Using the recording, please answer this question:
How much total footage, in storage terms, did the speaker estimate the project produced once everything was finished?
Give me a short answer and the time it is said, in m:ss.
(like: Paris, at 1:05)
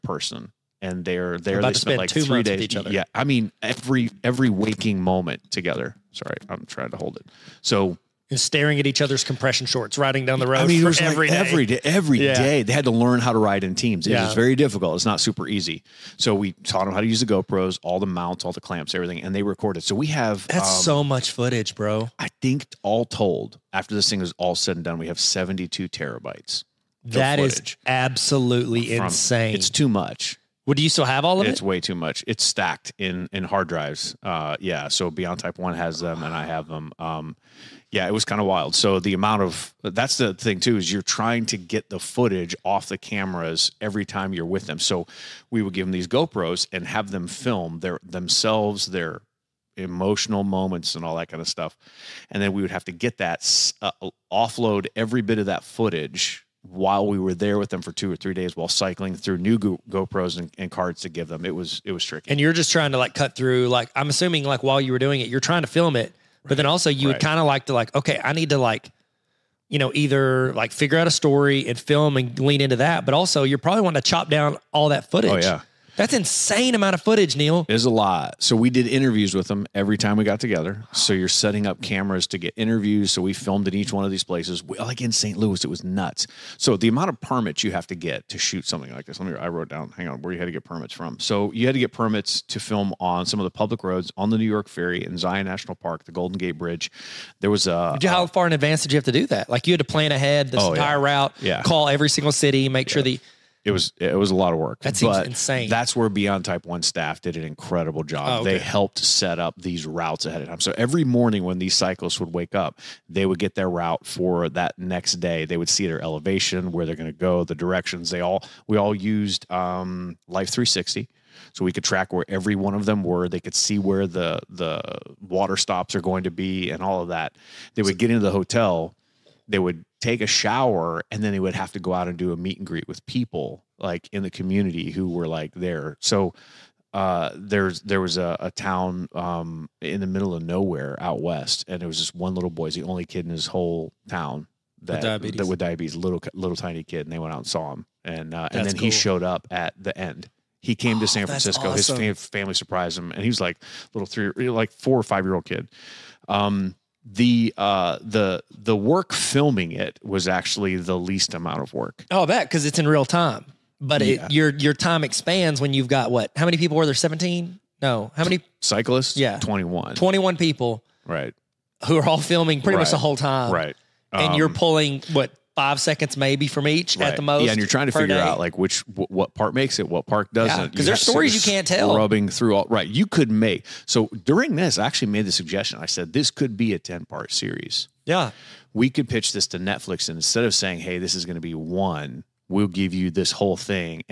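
72 terabytes, at 0:25.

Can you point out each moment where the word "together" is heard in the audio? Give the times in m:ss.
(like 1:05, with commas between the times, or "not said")
0:05, 1:20.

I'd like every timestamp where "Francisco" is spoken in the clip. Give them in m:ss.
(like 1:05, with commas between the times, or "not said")
2:31.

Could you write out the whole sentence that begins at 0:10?
I mean, it was every like day.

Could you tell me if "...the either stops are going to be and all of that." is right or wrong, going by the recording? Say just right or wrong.
wrong.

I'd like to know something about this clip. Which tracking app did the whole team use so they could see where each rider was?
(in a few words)
Life 360.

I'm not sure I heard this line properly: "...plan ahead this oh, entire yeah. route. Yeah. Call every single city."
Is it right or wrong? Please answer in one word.
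right.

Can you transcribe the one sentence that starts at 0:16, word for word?
So we taught them how to use the GoPros, all the mounts, all the clamps, everything, and they recorded.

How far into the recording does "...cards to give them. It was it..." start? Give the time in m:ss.
1:00.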